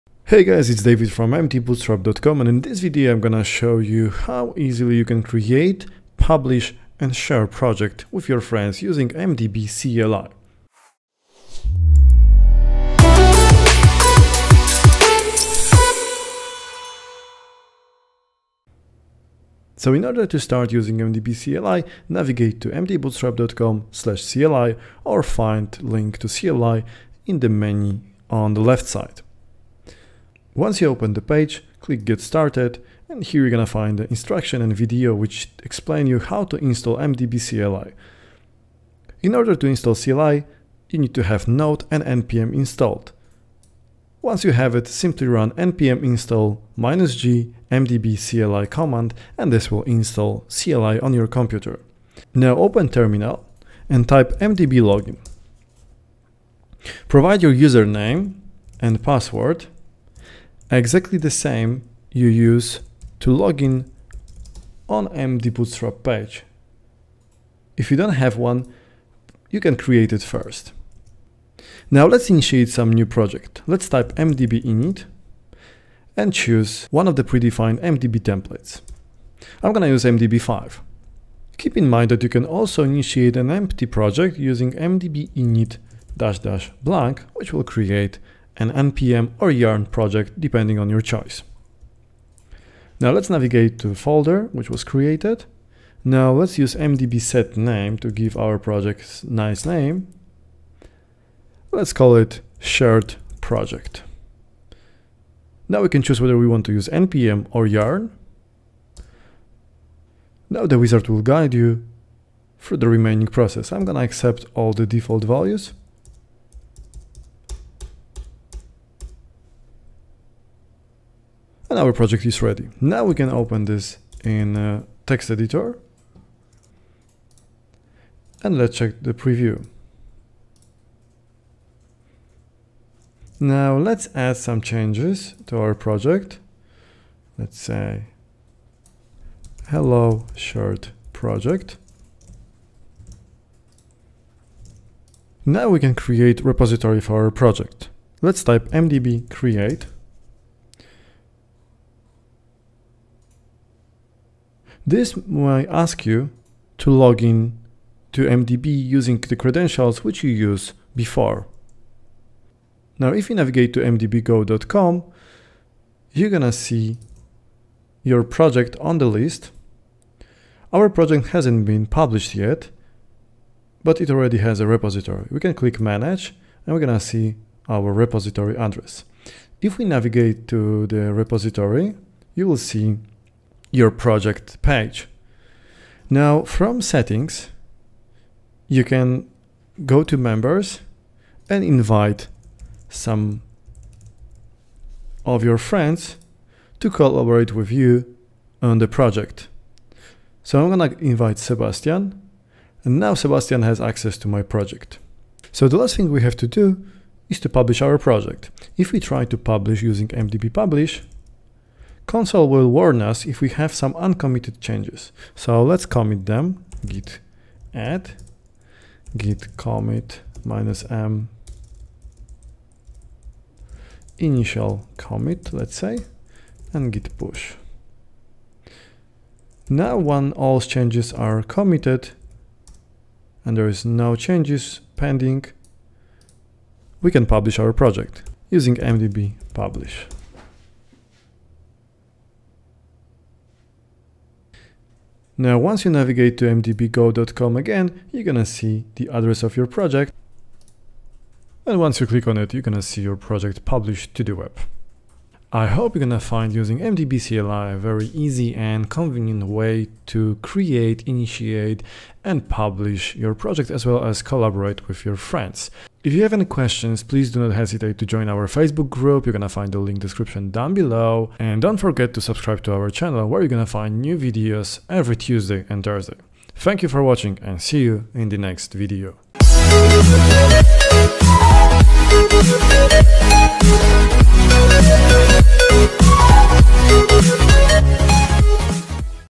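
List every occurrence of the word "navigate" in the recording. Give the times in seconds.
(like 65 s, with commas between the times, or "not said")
22 s, 93 s, 163 s, 179 s, 245 s.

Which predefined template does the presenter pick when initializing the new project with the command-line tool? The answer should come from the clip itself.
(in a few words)
mdb5.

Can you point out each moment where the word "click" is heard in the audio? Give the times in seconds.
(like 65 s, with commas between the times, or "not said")
31 s, 175 s, 252 s.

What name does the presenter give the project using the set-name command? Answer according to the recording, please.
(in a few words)
shared project.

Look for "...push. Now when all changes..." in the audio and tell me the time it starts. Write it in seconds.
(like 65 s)
227 s.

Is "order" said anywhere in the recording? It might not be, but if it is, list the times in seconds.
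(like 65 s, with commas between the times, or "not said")
20 s, 39 s.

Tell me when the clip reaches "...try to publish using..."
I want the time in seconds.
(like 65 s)
208 s.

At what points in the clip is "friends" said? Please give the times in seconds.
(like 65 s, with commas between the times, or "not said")
8 s, 195 s, 265 s.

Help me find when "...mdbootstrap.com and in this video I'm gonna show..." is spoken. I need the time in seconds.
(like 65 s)
1 s.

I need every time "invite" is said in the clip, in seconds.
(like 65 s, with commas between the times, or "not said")
191 s, 200 s.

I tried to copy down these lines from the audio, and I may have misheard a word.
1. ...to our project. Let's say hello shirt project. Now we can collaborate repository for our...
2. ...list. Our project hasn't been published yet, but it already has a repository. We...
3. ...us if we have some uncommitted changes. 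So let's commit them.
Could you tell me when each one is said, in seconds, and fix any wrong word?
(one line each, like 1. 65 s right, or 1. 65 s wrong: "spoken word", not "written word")
1. 135 s wrong: "create", not "collaborate"
2. 169 s right
3. 213 s right.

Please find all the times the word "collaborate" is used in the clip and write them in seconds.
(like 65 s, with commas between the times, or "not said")
196 s, 264 s.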